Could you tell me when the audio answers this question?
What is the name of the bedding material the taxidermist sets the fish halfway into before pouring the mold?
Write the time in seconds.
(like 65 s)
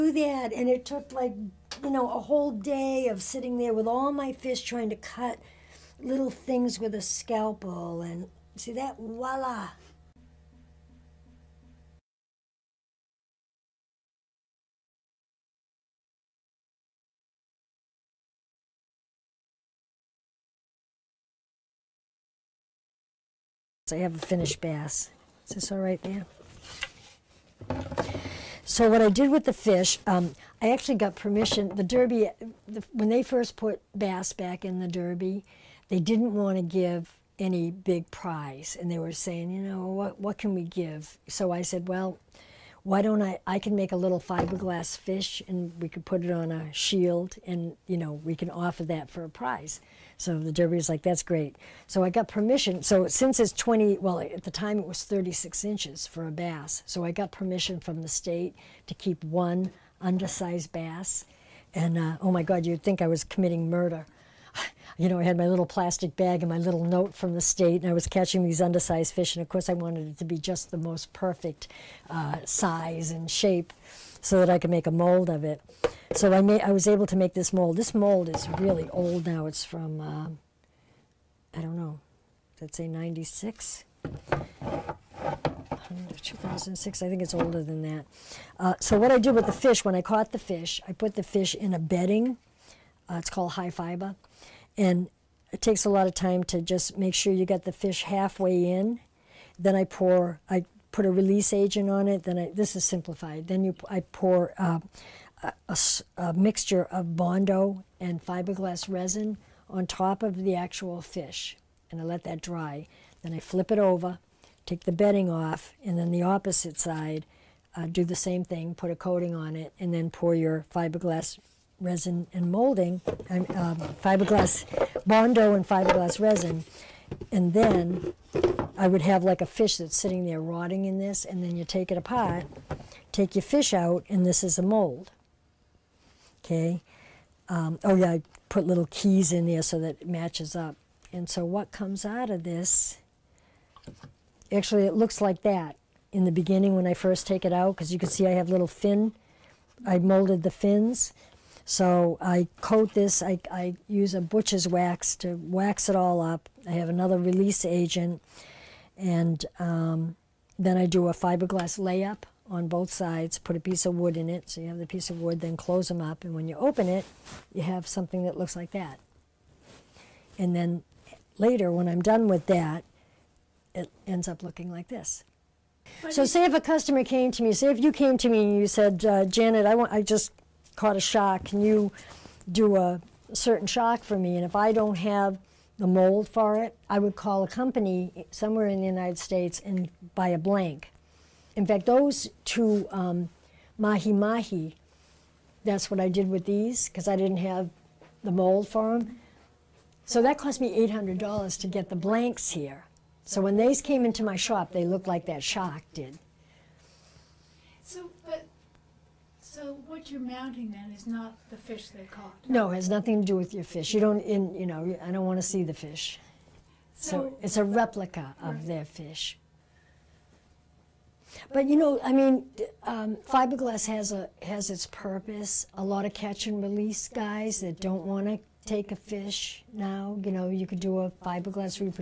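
93 s.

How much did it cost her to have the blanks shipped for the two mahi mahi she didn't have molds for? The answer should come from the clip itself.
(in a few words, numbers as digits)
$800.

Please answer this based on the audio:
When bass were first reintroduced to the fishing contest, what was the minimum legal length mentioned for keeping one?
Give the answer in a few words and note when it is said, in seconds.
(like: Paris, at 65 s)
36 inches, at 55 s.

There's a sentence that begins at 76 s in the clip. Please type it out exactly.
So I, made, I was able to make this mold.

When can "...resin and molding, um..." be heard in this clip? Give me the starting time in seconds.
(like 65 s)
121 s.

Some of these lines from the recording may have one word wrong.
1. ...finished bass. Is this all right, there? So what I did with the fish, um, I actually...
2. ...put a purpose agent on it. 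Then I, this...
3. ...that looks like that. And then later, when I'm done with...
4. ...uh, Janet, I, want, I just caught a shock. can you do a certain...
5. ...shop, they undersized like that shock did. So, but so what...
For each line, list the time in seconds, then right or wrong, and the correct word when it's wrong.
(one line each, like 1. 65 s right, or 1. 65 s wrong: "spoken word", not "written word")
1. 24 s right
2. 100 s wrong: "release", not "purpose"
3. 168 s right
4. 179 s right
5. 204 s wrong: "looked", not "undersized".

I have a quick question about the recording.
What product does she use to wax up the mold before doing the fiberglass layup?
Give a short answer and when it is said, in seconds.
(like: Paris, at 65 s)
butcher's wax, at 154 s.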